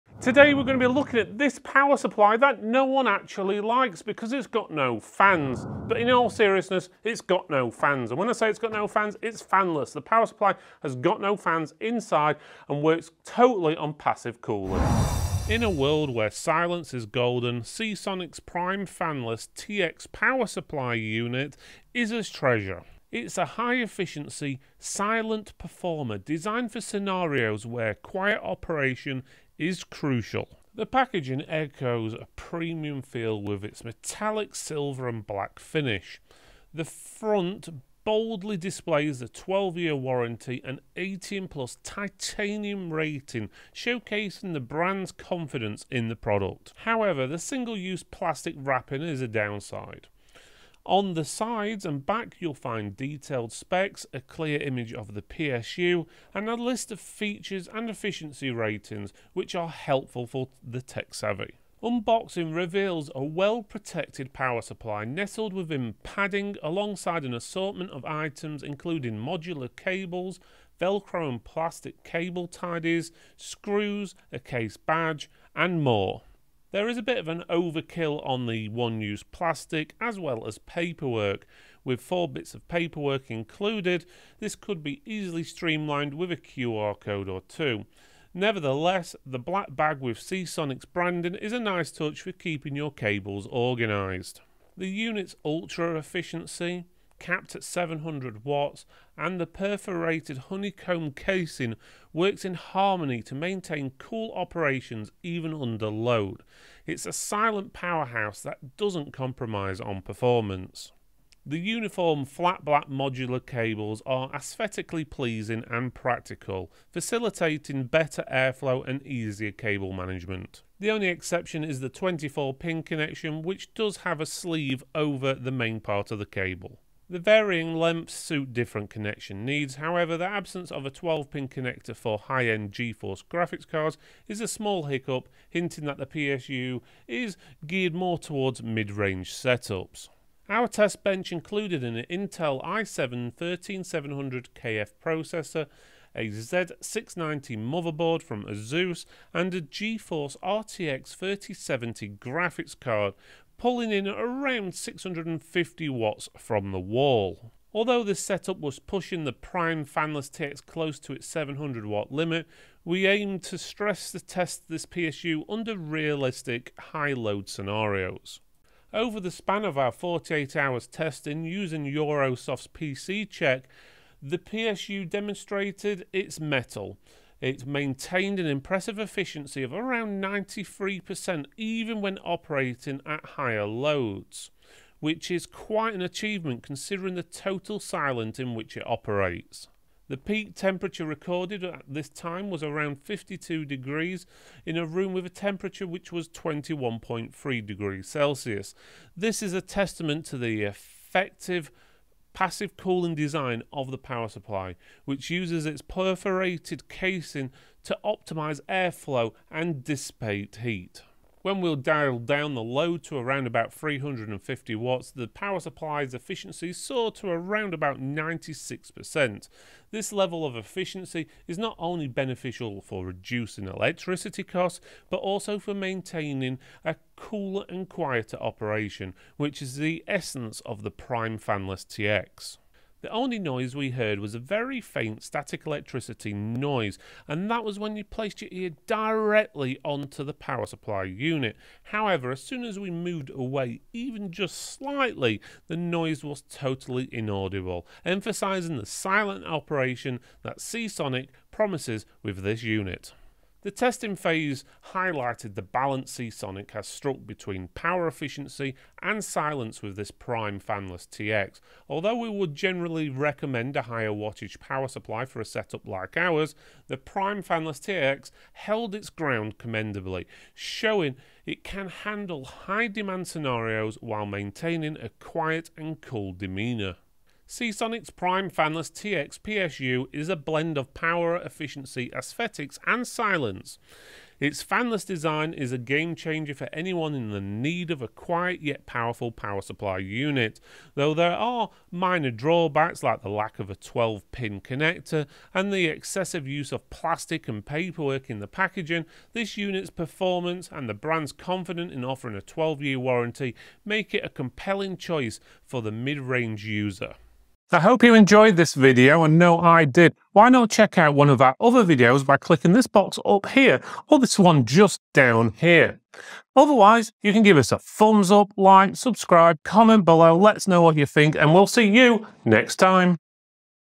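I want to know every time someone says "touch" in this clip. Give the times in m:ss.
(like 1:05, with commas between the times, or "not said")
1:31.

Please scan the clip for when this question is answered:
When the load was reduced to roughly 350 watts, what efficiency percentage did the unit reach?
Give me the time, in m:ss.
3:37.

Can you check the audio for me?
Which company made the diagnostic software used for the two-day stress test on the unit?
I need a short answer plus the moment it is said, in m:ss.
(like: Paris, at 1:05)
Eurosoft, at 2:51.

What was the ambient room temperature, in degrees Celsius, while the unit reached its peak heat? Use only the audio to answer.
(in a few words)
21.3.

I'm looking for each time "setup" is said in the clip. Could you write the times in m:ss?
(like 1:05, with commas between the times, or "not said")
2:19, 2:38, 4:25.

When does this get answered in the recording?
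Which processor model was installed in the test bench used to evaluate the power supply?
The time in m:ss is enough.
2:22.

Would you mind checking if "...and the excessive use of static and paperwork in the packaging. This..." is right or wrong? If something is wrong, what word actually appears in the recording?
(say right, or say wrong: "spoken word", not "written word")
wrong: "plastic", not "static".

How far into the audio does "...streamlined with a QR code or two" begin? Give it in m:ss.
1:25.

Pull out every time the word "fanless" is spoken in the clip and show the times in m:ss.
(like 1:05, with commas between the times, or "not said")
0:09, 0:18, 2:39, 3:51, 4:20, 4:27, 4:38, 4:44.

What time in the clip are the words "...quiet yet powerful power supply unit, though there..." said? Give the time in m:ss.
4:48.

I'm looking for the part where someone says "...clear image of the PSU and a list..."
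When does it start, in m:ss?
0:54.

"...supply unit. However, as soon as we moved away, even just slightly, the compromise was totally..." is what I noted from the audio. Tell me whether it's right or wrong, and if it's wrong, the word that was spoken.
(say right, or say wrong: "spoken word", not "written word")
wrong: "noise", not "compromise".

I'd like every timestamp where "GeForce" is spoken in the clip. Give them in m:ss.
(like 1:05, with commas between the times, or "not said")
2:12, 2:29.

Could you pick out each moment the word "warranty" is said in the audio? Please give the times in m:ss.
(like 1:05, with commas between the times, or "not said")
0:39, 5:02.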